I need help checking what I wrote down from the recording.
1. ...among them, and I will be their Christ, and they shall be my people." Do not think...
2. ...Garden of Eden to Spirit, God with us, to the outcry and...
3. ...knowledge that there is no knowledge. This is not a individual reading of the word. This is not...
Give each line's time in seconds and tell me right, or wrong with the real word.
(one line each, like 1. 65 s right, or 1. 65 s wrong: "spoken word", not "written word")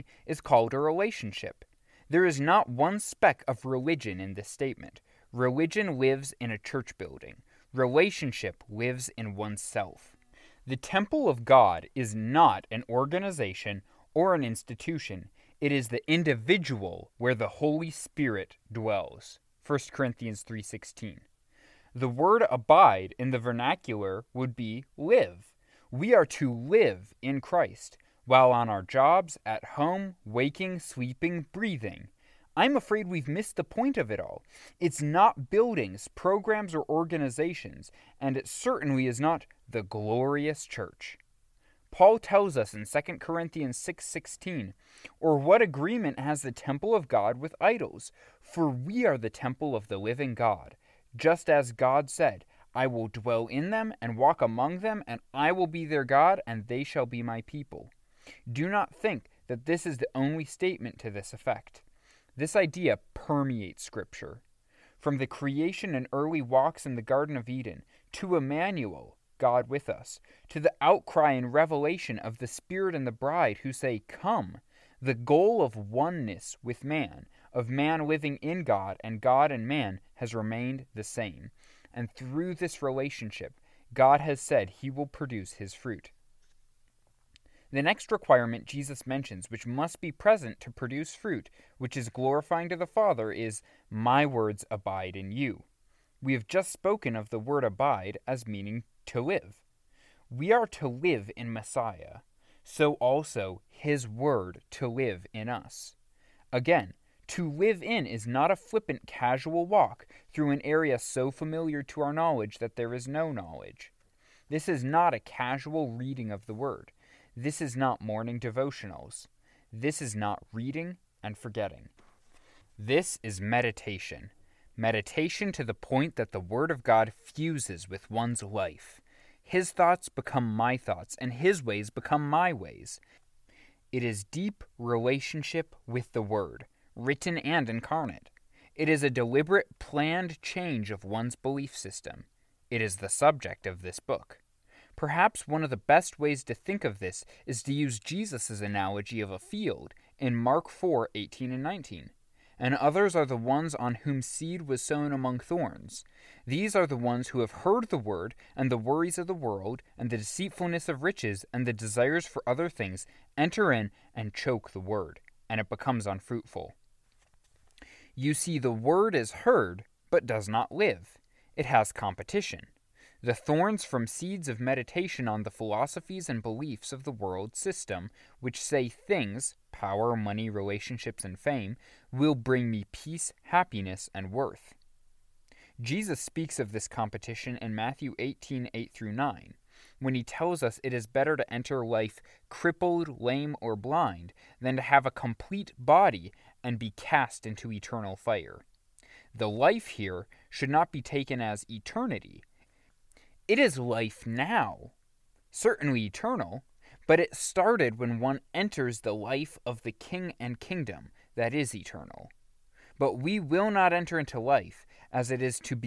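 1. 54 s wrong: "God", not "Christ"
2. 67 s wrong: "Emmanuel", not "Spirit"
3. 112 s wrong: "casual", not "individual".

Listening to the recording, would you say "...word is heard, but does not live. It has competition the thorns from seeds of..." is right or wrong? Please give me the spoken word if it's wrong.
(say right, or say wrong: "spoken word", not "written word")
right.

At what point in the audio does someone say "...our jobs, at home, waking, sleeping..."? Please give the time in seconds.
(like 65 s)
28 s.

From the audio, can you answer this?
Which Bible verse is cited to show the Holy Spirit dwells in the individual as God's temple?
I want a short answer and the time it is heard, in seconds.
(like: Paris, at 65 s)
1 Corinthians 3:16, at 19 s.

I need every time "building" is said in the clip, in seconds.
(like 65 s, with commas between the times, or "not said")
6 s, 35 s.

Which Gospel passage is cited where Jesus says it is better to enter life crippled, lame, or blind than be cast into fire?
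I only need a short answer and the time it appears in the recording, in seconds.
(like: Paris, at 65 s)
Matthew 18:8-9, at 187 s.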